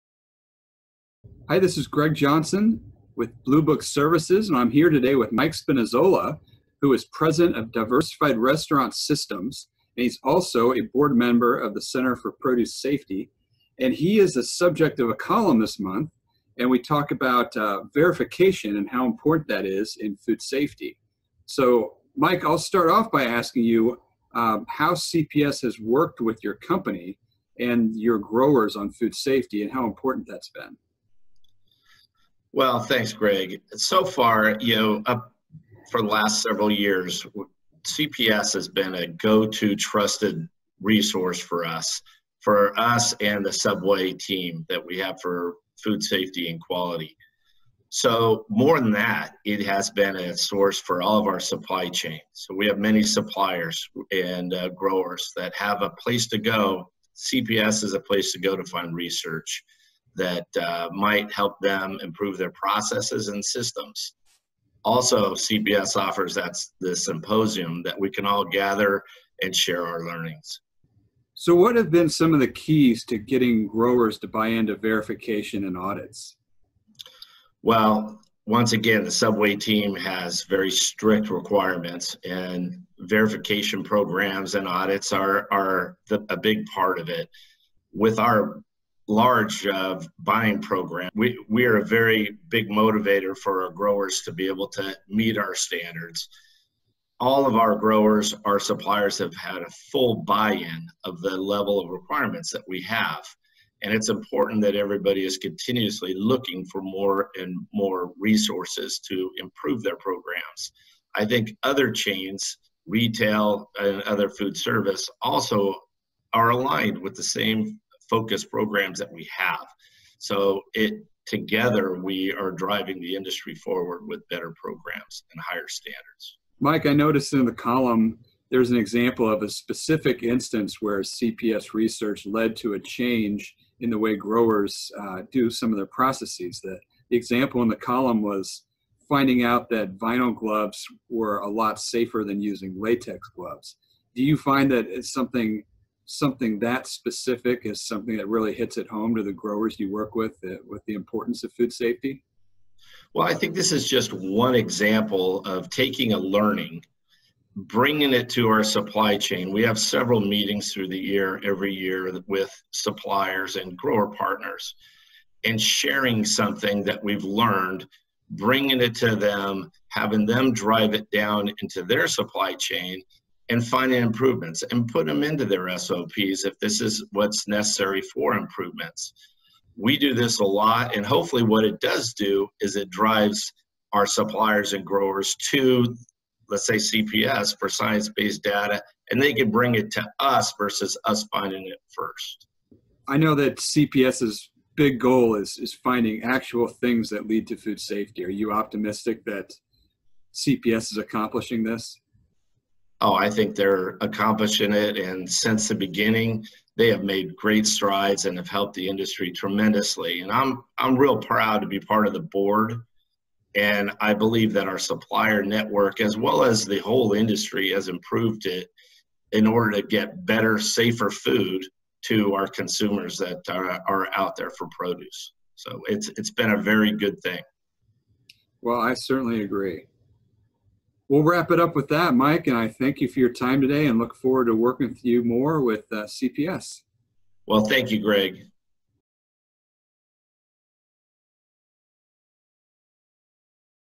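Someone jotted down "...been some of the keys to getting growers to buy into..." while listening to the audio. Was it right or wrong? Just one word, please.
right.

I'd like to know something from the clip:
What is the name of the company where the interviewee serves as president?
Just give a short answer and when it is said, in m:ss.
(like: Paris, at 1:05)
Diversified Restaurant Systems, at 0:07.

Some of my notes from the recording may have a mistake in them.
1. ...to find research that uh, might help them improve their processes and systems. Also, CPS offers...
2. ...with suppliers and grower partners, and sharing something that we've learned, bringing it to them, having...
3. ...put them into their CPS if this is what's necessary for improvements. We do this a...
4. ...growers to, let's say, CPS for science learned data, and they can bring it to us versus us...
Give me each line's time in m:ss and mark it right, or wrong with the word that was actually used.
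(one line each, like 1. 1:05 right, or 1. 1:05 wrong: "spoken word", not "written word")
1. 0:58 right
2. 2:42 right
3. 2:54 wrong: "SOPs", not "CPS"
4. 3:04 wrong: "based", not "learned".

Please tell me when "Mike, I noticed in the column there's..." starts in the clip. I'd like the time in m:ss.
2:06.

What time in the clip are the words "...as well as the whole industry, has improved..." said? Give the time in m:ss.
3:35.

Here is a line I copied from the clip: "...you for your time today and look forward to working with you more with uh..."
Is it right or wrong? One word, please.
right.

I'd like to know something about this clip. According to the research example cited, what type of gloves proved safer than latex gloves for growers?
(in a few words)
Vinyl gloves.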